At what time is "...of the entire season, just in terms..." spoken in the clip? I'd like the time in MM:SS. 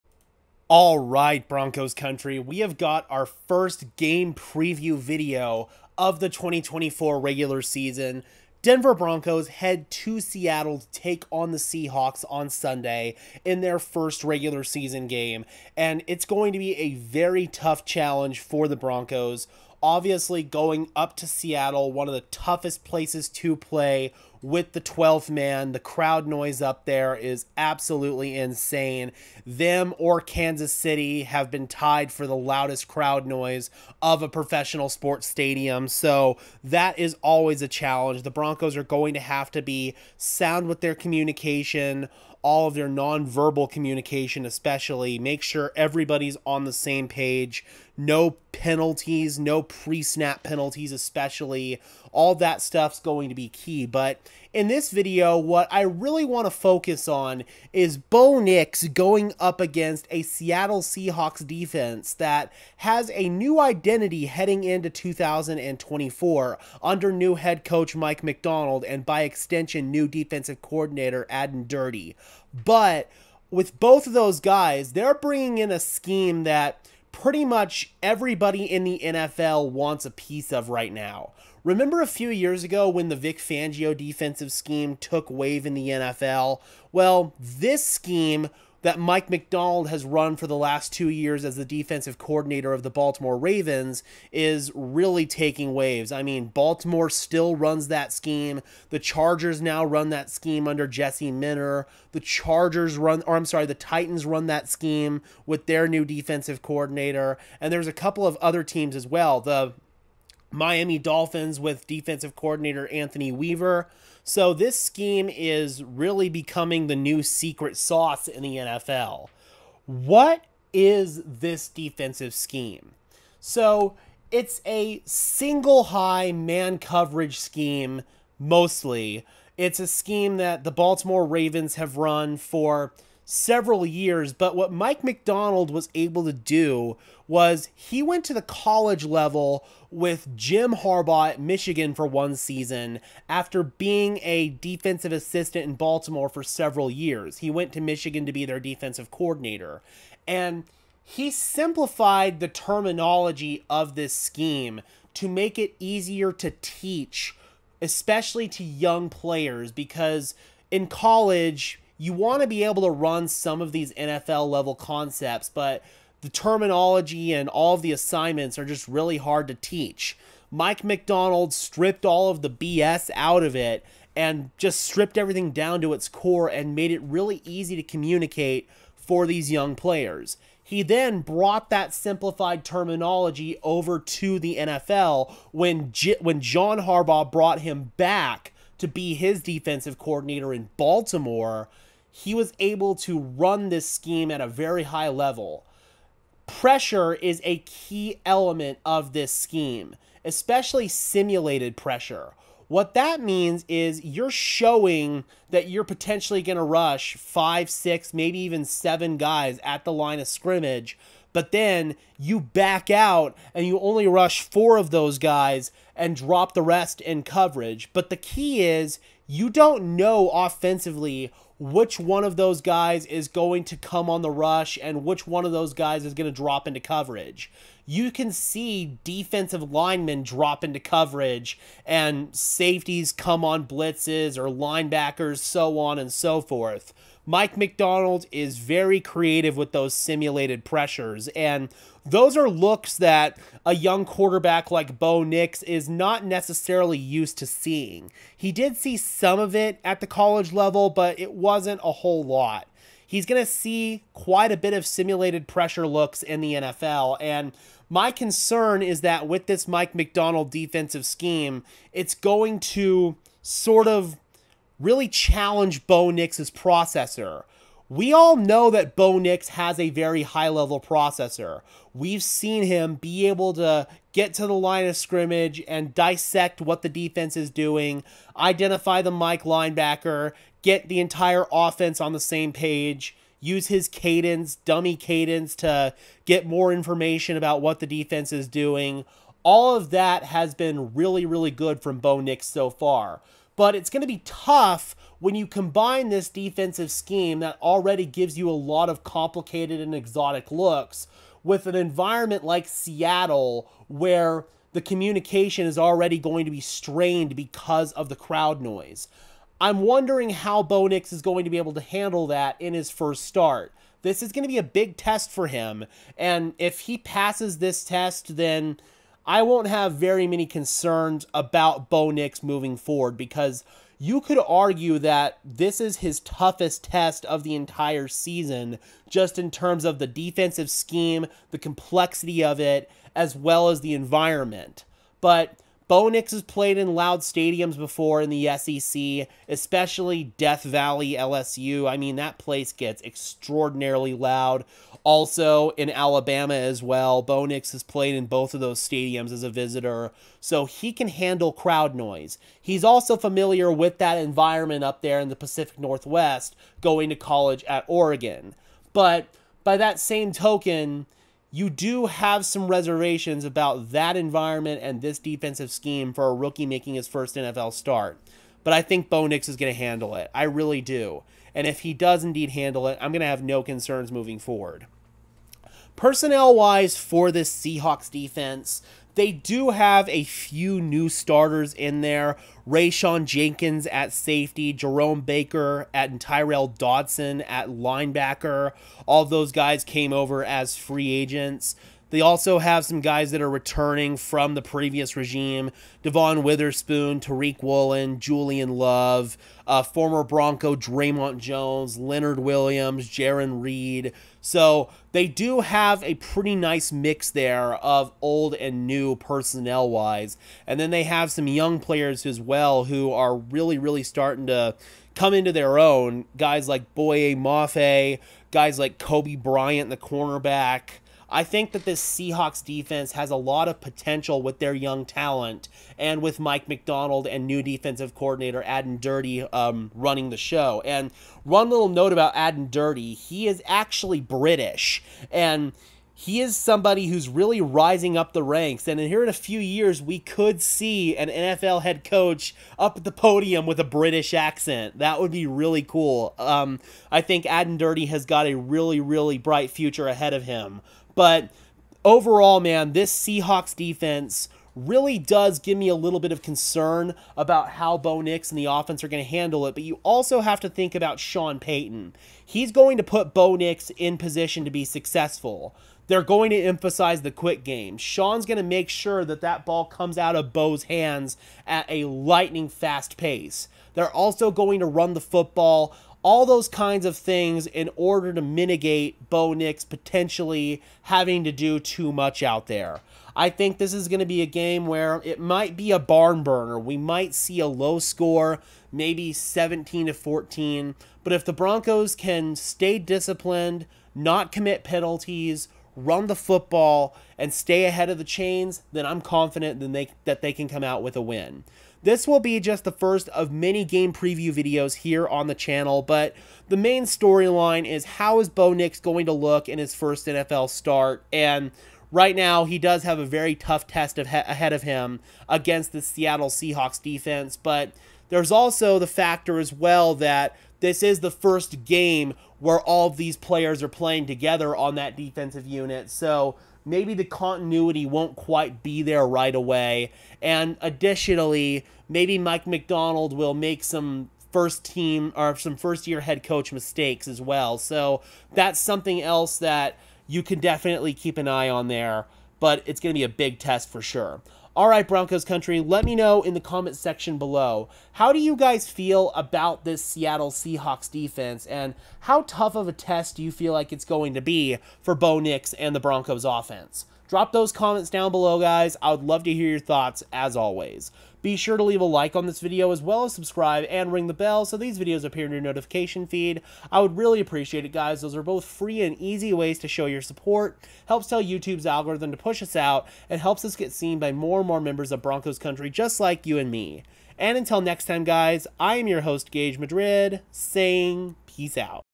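05:27.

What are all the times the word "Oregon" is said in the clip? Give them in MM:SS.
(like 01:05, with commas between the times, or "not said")
05:57.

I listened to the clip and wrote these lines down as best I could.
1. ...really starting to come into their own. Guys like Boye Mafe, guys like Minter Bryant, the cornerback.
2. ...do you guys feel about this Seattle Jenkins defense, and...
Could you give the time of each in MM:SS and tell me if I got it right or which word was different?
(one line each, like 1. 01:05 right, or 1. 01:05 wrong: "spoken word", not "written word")
1. 06:53 wrong: "Coby", not "Minter"
2. 09:08 wrong: "Seahawks", not "Jenkins".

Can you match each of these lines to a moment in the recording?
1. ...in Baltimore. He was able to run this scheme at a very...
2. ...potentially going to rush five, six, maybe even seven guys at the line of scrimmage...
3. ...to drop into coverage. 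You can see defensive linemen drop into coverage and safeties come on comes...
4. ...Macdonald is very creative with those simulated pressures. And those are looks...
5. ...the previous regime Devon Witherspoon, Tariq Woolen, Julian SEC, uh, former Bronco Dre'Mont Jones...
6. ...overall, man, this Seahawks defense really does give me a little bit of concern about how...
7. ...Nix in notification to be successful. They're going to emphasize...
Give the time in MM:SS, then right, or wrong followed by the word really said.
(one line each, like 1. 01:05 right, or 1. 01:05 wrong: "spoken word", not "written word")
1. 03:10 right
2. 03:25 right
3. 03:46 wrong: "blitzes", not "comes"
4. 03:57 right
5. 06:34 wrong: "Love", not "SEC"
6. 07:32 right
7. 07:43 wrong: "position", not "notification".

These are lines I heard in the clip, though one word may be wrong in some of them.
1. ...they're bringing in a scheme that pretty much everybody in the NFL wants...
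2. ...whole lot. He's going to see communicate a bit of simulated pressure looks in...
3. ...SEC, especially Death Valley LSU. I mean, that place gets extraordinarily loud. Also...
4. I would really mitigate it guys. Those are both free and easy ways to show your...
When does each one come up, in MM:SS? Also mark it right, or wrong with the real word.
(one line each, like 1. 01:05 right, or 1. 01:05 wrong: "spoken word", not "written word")
1. 01:14 right
2. 04:11 wrong: "quite", not "communicate"
3. 05:38 right
4. 09:26 wrong: "appreciate", not "mitigate".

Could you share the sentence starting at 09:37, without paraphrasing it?
And until next time guys, I am your host Gage Madrid saying peace out.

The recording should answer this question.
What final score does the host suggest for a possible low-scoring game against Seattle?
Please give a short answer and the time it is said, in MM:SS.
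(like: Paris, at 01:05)
17 to 14, at 08:09.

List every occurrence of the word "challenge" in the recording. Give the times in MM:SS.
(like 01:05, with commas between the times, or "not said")
00:17, 00:37, 04:25.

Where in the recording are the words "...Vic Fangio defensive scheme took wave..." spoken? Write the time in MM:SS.
01:23.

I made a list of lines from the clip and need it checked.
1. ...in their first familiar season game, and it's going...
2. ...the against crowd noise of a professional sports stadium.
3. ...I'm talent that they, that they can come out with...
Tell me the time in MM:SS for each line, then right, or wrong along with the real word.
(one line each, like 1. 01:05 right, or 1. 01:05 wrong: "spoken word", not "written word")
1. 00:13 wrong: "regular", not "familiar"
2. 00:32 wrong: "loudest", not "against"
3. 08:19 wrong: "confident", not "talent".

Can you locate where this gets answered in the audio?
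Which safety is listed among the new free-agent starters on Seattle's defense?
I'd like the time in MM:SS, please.
06:22.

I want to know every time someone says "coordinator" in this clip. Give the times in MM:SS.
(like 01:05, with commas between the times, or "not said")
01:10, 01:32, 01:46, 01:52, 02:29, 03:09, 07:08.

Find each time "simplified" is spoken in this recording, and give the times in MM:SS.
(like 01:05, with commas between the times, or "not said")
02:31, 03:01.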